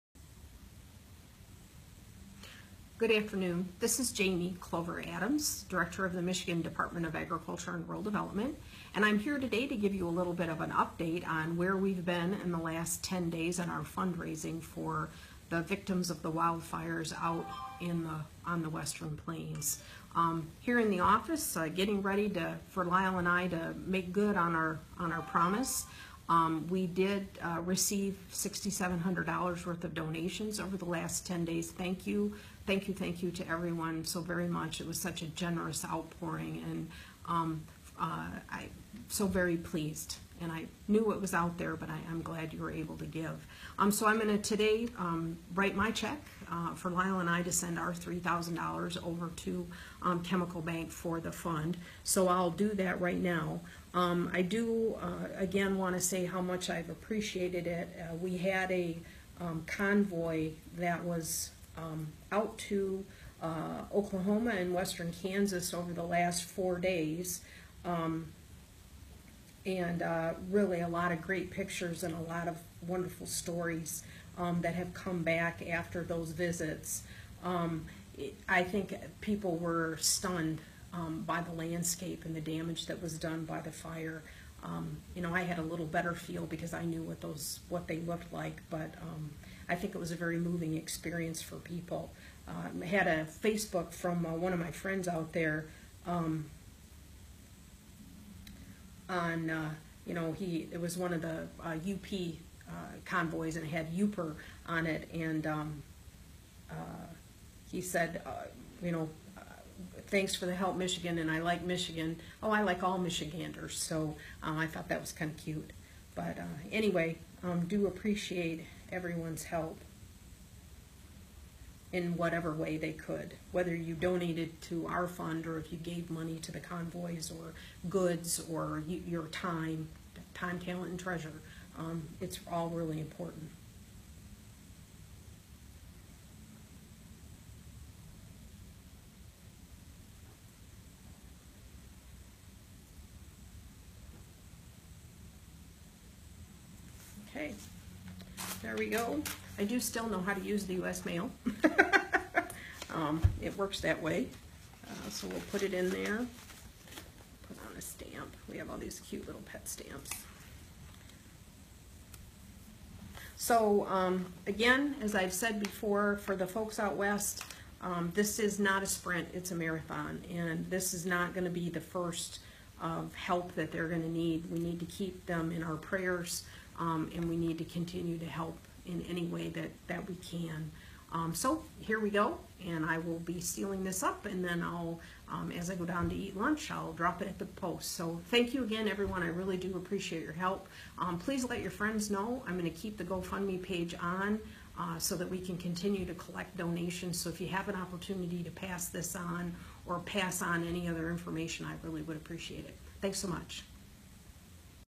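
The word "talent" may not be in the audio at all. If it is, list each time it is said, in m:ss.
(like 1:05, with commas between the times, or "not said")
2:10.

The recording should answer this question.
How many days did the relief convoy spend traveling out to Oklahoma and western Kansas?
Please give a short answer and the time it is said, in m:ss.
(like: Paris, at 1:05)
4, at 1:06.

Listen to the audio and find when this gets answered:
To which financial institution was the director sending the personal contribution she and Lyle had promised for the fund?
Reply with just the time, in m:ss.
0:50.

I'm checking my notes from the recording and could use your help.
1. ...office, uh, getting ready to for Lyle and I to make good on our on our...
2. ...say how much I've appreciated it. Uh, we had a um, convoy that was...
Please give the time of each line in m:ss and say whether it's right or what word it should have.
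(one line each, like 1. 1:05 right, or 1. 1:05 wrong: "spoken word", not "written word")
1. 0:20 right
2. 0:56 right.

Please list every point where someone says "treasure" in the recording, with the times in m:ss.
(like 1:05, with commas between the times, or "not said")
2:10.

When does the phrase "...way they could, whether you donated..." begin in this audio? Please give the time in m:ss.
2:02.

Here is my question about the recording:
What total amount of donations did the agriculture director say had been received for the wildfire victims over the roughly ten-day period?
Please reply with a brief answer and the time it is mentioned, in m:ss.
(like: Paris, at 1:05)
$6,700, at 0:28.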